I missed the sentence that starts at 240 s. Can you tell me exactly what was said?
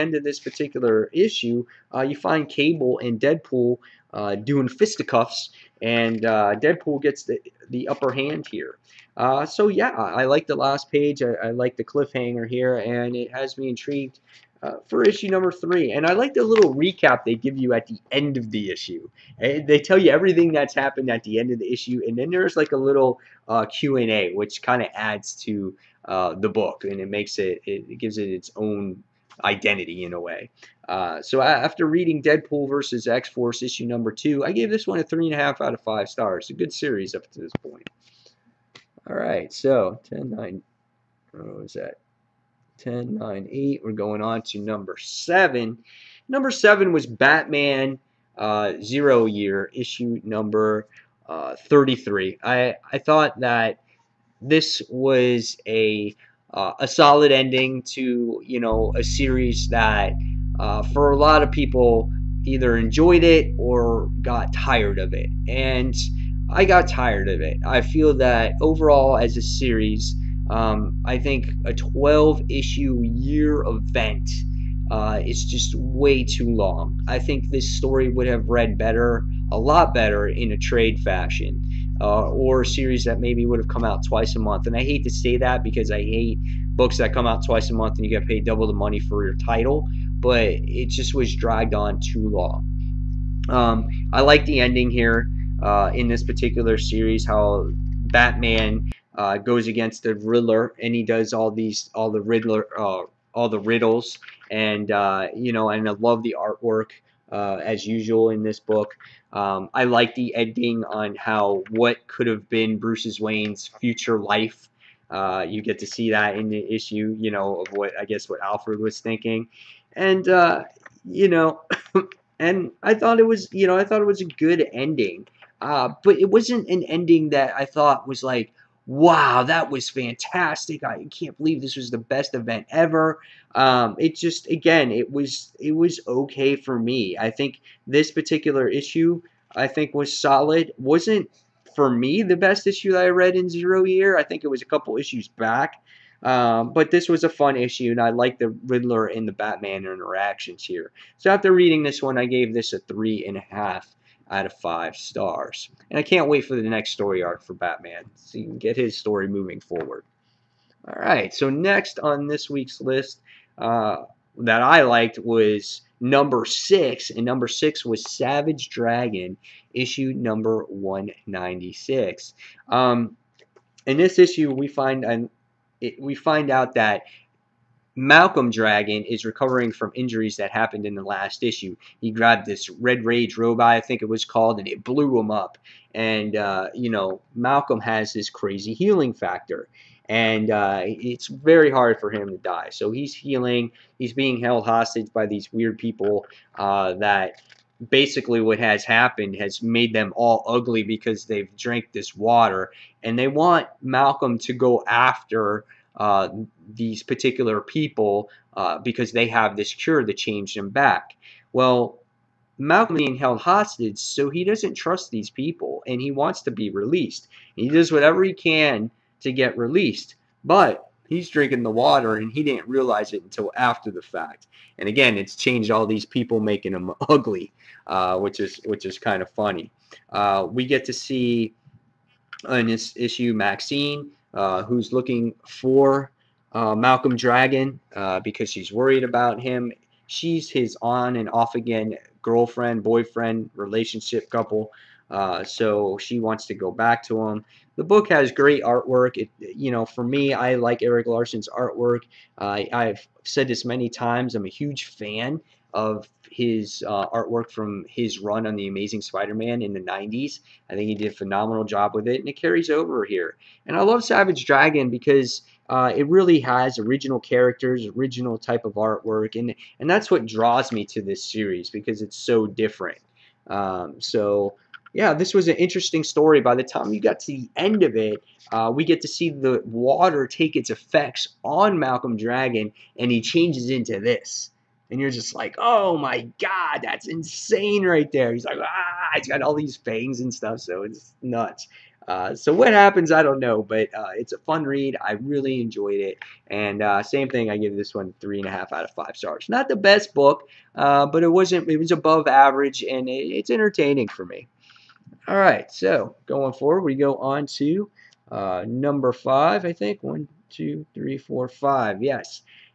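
She's his on and off again girlfriend, boyfriend, relationship couple.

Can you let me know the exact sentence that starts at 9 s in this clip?
Uh, so, yeah, I like the last page.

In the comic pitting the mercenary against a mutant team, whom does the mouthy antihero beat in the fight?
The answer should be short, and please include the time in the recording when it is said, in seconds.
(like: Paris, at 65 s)
Cable, at 2 s.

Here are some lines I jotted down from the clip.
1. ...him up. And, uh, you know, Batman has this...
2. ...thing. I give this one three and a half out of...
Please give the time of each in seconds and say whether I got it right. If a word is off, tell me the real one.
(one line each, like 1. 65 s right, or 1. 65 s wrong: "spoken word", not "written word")
1. 185 s wrong: "Malcolm", not "Batman"
2. 297 s right.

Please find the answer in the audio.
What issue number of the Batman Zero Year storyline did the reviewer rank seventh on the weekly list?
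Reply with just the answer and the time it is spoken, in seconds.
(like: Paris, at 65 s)
33, at 51 s.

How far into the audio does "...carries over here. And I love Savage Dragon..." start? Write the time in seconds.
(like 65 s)
262 s.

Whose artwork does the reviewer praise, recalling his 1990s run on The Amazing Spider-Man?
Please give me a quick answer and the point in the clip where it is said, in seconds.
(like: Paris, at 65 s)
Erik Larsen, at 250 s.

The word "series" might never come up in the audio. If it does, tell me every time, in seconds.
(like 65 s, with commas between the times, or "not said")
36 s, 59 s, 69 s, 82 s, 96 s, 271 s.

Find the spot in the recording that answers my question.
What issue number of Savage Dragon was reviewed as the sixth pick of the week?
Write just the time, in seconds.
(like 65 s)
170 s.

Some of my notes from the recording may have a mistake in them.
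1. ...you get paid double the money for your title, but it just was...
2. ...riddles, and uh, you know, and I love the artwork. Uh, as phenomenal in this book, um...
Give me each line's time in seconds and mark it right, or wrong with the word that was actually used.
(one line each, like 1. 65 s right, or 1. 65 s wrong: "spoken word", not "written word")
1. 88 s right
2. 103 s wrong: "usual", not "phenomenal".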